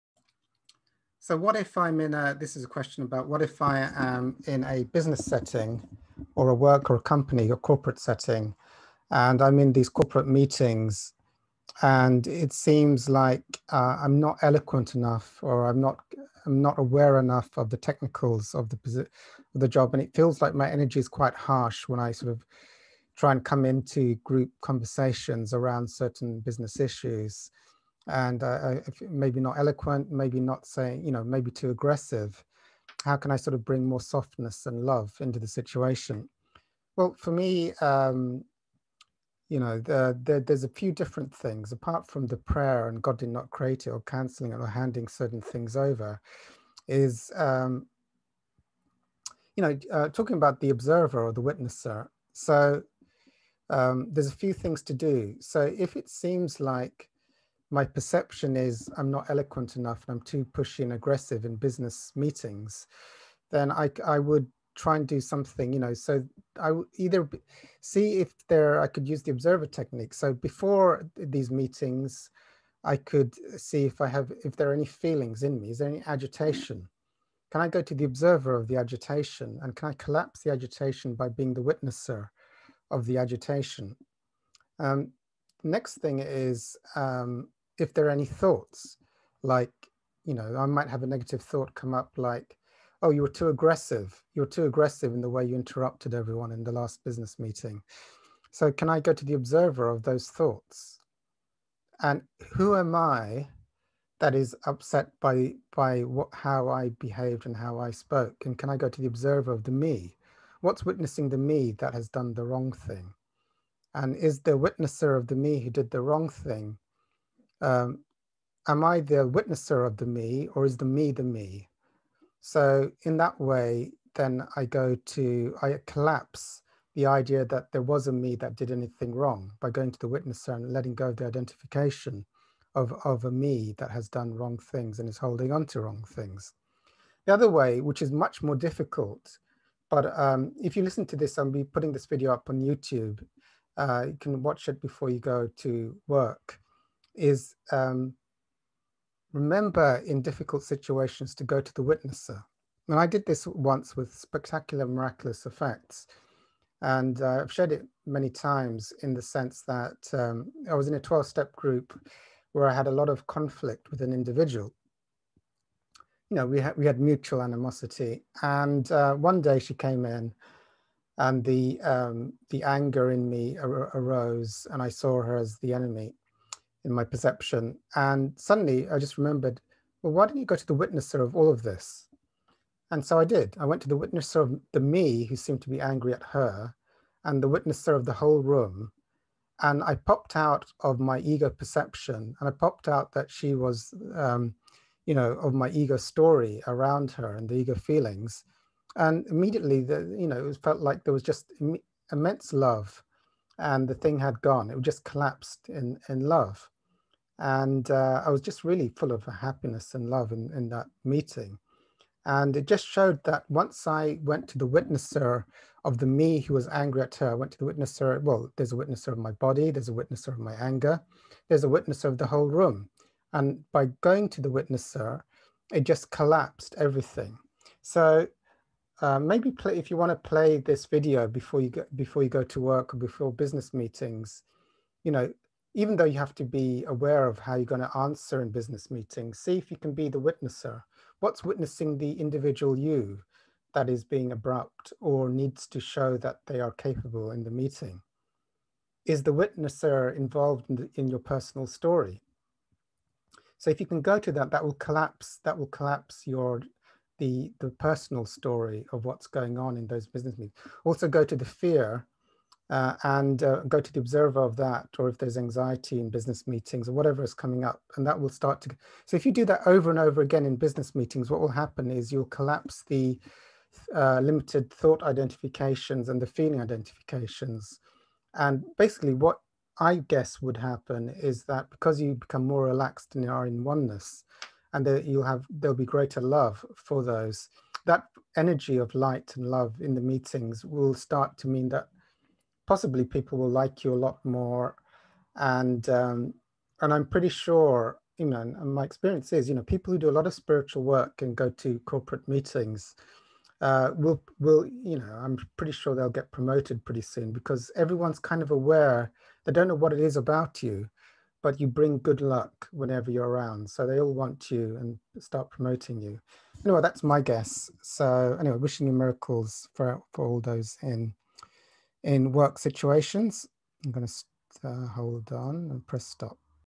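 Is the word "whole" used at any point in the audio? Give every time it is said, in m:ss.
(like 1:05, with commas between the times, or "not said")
3:08, 3:42.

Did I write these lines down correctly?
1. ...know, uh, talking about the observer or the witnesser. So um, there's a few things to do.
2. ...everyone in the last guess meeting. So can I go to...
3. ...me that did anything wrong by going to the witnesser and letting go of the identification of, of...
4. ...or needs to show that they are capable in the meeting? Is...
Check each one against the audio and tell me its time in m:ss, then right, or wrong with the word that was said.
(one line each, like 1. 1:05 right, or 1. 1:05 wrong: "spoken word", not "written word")
1. 0:49 right
2. 1:36 wrong: "business", not "guess"
3. 2:08 right
4. 4:04 right.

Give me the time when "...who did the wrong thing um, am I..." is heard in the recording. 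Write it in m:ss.
1:55.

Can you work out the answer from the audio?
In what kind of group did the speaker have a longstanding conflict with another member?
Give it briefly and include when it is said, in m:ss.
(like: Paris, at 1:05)
12 step group, at 2:40.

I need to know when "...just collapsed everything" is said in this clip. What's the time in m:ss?
3:45.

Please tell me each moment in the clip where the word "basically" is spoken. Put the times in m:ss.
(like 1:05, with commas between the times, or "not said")
4:38.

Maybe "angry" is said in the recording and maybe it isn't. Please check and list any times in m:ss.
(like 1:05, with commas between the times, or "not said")
3:05, 3:36.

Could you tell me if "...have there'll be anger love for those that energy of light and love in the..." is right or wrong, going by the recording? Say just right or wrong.
wrong.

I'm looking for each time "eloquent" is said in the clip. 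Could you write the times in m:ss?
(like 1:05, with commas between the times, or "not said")
0:14, 0:29, 0:59.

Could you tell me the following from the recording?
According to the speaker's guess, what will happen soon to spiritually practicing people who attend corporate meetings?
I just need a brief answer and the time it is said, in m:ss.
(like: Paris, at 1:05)
They'll get promoted, at 5:06.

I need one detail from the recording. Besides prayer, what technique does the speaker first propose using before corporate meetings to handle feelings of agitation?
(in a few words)
The observer technique.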